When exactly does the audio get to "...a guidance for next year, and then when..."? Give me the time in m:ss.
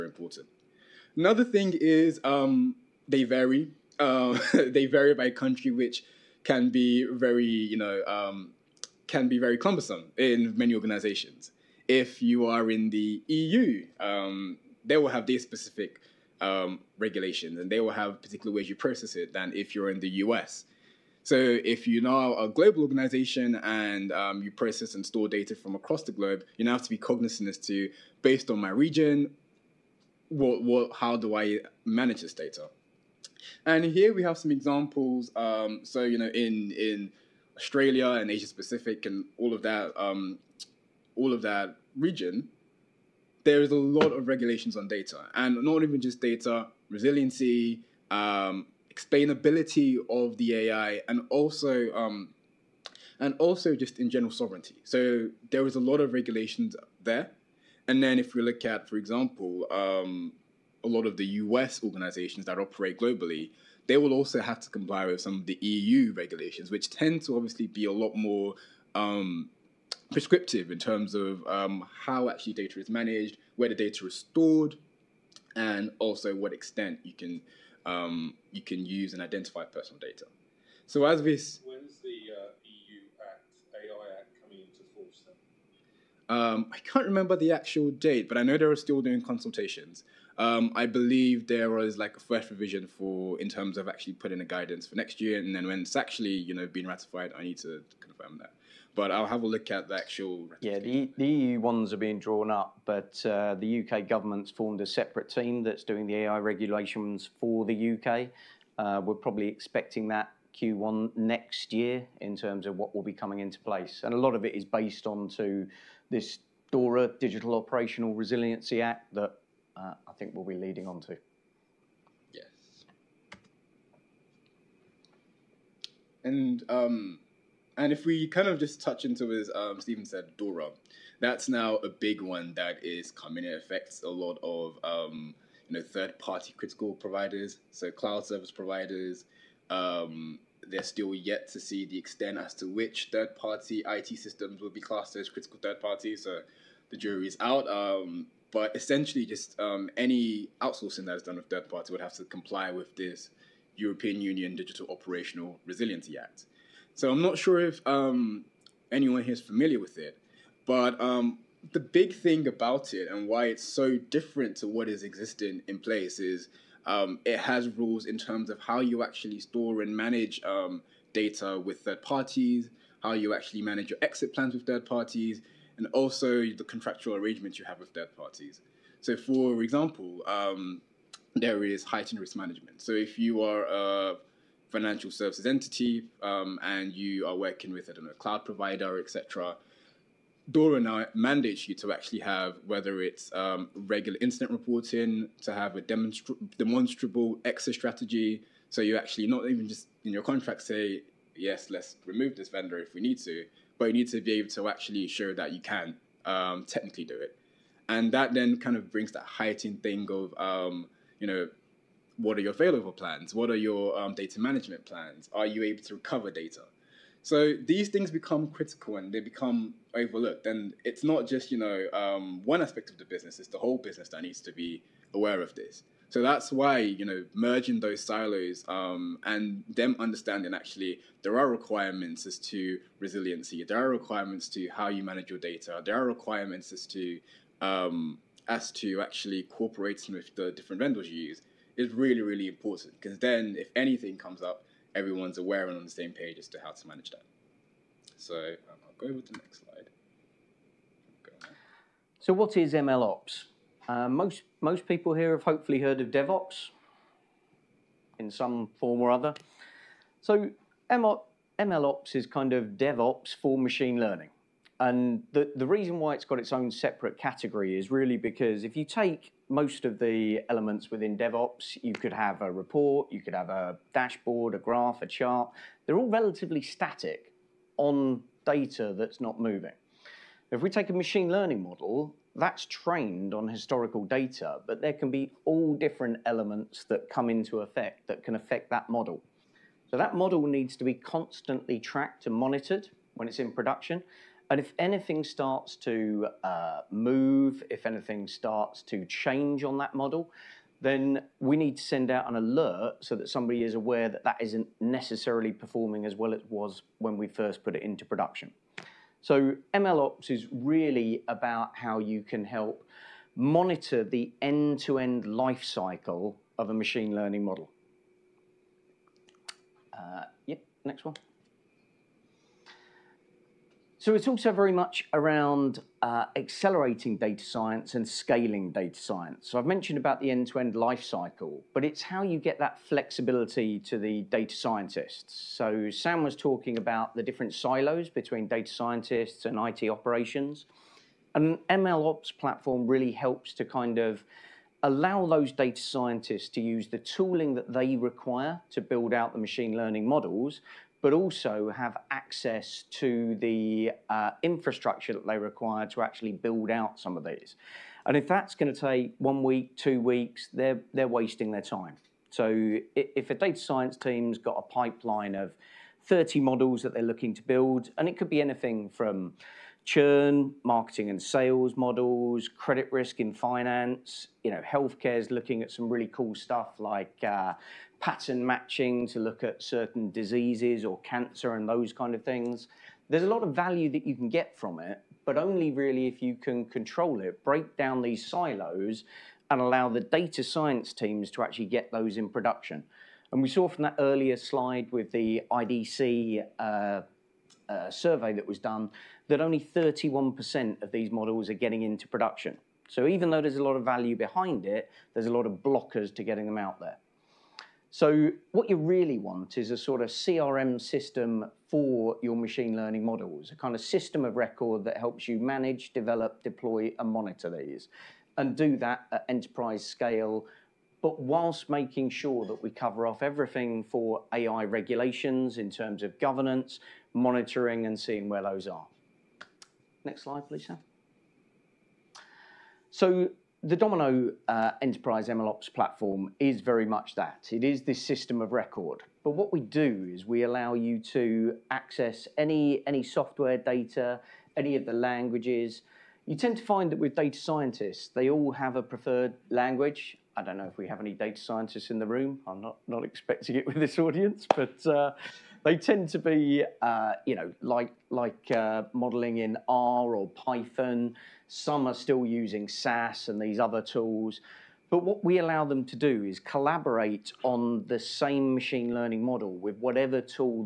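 1:34.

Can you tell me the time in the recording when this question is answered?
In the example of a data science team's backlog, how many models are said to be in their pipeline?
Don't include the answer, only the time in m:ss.
6:06.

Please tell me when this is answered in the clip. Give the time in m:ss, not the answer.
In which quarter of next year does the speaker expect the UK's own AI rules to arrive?
1:50.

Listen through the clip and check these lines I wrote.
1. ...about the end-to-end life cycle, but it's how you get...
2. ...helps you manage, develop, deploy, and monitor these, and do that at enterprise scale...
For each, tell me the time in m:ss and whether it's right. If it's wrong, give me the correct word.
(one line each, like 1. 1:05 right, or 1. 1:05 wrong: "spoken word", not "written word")
1. 5:29 right
2. 6:54 right.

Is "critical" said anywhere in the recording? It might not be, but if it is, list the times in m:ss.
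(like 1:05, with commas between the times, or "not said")
2:16, 2:25, 3:38.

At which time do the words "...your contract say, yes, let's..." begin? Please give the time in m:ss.
3:20.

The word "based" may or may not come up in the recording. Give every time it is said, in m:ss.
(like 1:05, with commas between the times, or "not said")
0:28, 1:54.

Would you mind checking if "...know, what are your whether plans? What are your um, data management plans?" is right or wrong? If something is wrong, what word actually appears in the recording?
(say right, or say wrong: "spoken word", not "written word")
wrong: "failover", not "whether".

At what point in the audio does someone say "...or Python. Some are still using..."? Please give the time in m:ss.
7:40.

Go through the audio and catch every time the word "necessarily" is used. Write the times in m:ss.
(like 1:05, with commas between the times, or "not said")
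5:04.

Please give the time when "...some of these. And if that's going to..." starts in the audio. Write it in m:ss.
5:56.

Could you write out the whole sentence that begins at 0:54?
So there is a lot of regulations there, and then if we look at, for example, um, a lot of the U.S.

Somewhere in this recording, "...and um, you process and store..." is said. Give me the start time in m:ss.
0:23.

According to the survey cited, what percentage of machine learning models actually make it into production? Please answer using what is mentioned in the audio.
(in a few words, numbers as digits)
31%.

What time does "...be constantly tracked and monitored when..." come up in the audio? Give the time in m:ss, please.
4:50.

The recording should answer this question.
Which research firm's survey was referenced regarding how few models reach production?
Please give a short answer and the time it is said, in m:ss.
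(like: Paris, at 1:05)
IDC, at 6:35.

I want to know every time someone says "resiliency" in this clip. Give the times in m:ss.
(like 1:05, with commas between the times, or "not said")
0:46, 1:58, 2:35, 3:52.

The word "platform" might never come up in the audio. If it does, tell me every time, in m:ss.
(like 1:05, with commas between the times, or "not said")
5:42, 7:15.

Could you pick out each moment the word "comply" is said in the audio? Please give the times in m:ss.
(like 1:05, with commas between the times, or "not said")
1:04, 2:32.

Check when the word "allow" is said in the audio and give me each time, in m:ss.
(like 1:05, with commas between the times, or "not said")
5:44, 6:29, 7:20, 7:45.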